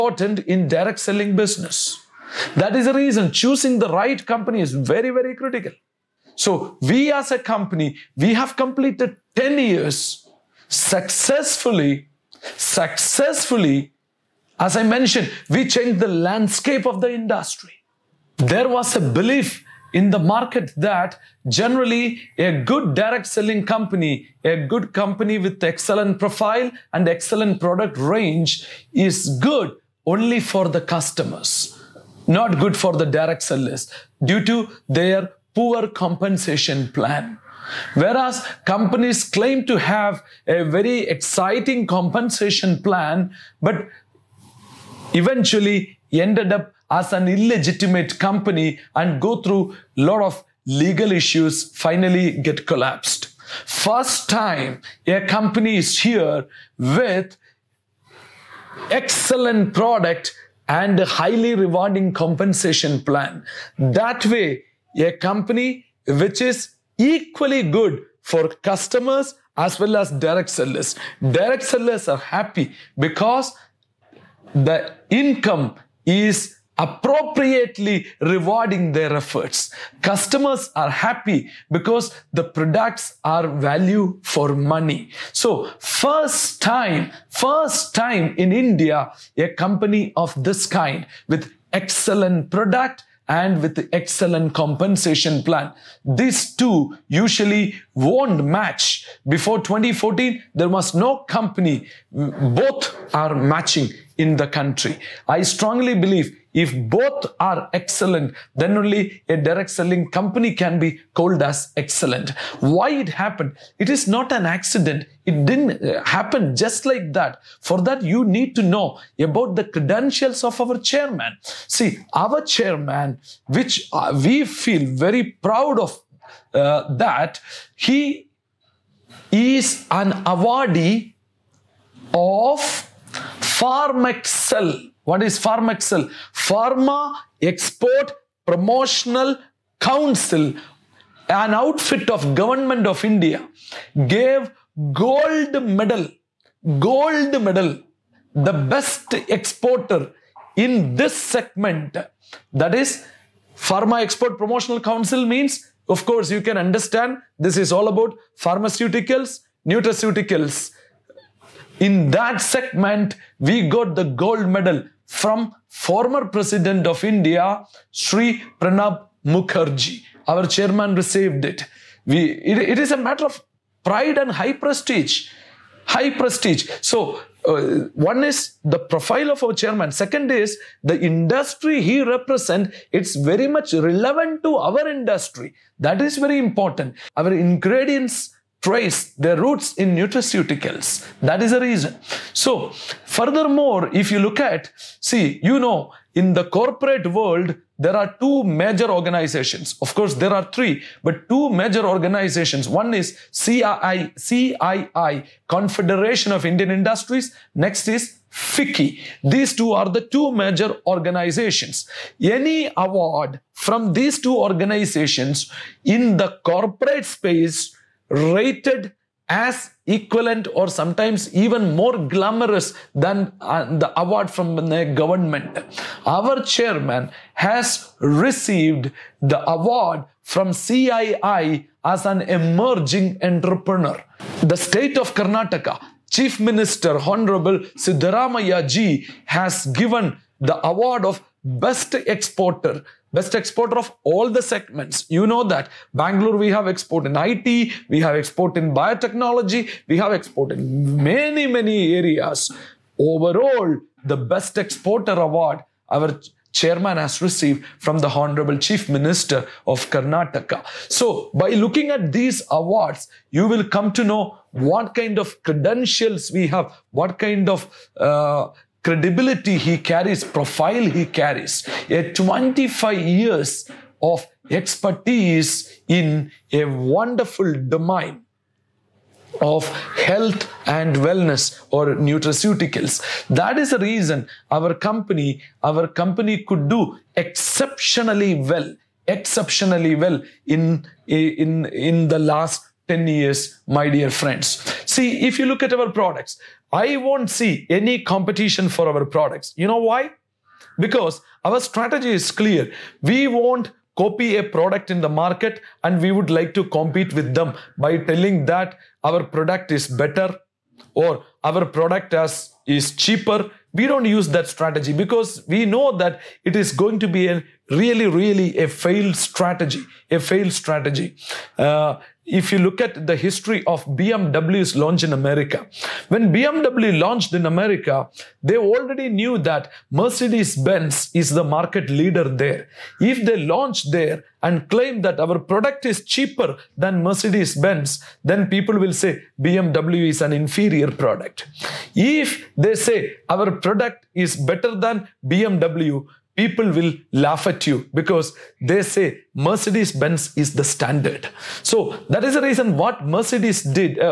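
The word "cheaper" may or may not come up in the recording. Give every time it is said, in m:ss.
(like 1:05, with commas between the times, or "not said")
5:12, 5:36.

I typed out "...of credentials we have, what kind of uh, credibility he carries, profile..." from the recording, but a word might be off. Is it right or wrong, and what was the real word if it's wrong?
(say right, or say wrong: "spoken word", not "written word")
right.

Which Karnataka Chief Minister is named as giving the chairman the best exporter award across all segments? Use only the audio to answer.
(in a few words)
Siddaramaiah.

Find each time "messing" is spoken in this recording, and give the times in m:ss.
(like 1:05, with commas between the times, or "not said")
not said.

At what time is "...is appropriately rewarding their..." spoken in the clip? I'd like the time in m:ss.
1:16.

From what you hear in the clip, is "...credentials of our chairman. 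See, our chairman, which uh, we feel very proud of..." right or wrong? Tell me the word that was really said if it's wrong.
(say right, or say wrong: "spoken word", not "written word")
right.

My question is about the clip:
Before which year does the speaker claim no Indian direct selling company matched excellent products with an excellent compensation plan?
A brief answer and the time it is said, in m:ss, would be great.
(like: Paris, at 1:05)
2014, at 1:39.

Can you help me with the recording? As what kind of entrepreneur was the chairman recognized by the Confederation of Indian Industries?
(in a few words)
emerging entrepreneur.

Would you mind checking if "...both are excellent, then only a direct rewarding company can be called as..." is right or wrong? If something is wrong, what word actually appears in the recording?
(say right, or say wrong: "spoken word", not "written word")
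wrong: "selling", not "rewarding".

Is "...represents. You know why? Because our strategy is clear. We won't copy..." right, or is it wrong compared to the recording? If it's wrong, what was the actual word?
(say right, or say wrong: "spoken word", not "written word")
wrong: "products", not "represents".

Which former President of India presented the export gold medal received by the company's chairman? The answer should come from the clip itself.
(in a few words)
Pranab Mukherjee.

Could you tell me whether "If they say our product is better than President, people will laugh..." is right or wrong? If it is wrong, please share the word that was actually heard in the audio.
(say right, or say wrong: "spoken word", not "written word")
wrong: "BMW", not "President".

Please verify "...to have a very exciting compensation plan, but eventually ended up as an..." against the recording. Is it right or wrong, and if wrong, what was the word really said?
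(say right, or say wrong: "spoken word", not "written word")
right.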